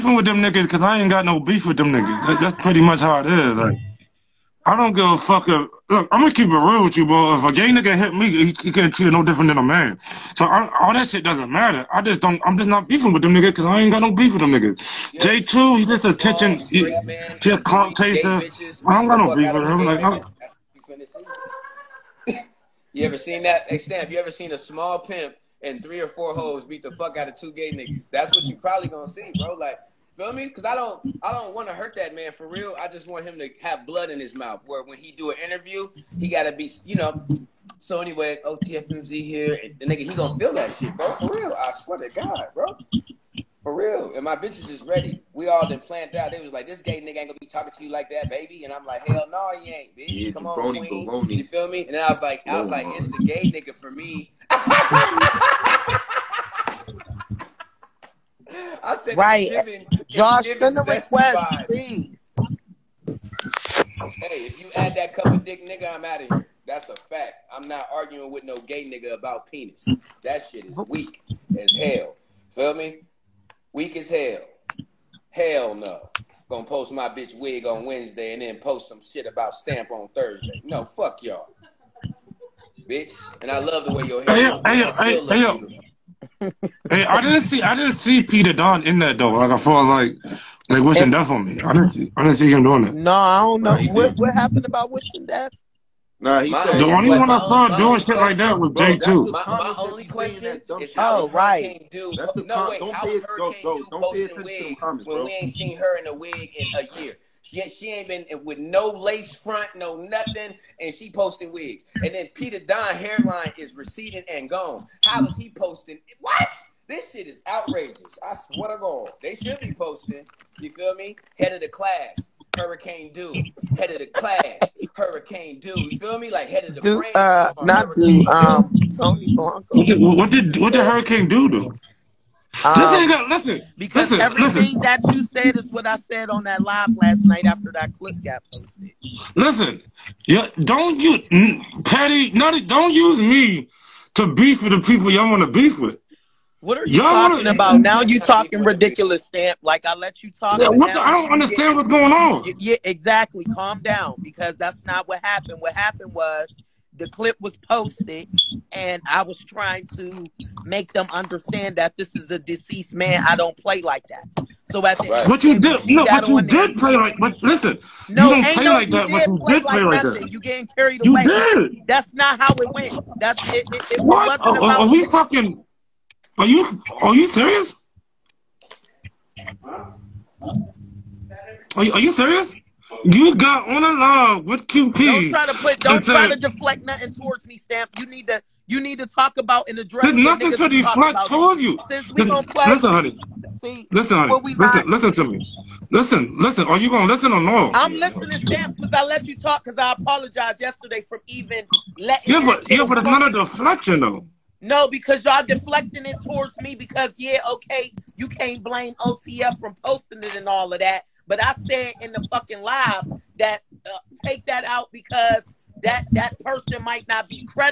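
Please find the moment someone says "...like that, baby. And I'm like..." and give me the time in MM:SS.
00:47.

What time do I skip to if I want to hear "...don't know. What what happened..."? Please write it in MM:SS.
01:33.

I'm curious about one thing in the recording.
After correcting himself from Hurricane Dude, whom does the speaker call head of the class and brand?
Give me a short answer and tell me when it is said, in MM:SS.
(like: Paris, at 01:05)
Tony Blanco, at 02:08.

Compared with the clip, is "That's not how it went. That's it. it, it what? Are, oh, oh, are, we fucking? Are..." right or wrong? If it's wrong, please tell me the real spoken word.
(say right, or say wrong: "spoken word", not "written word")
right.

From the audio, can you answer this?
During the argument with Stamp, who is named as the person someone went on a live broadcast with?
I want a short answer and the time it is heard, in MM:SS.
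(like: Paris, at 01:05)
QP, at 03:04.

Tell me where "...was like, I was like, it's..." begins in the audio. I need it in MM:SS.
00:52.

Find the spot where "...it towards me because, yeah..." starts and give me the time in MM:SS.
03:26.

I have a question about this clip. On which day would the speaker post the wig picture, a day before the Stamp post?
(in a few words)
Wednesday.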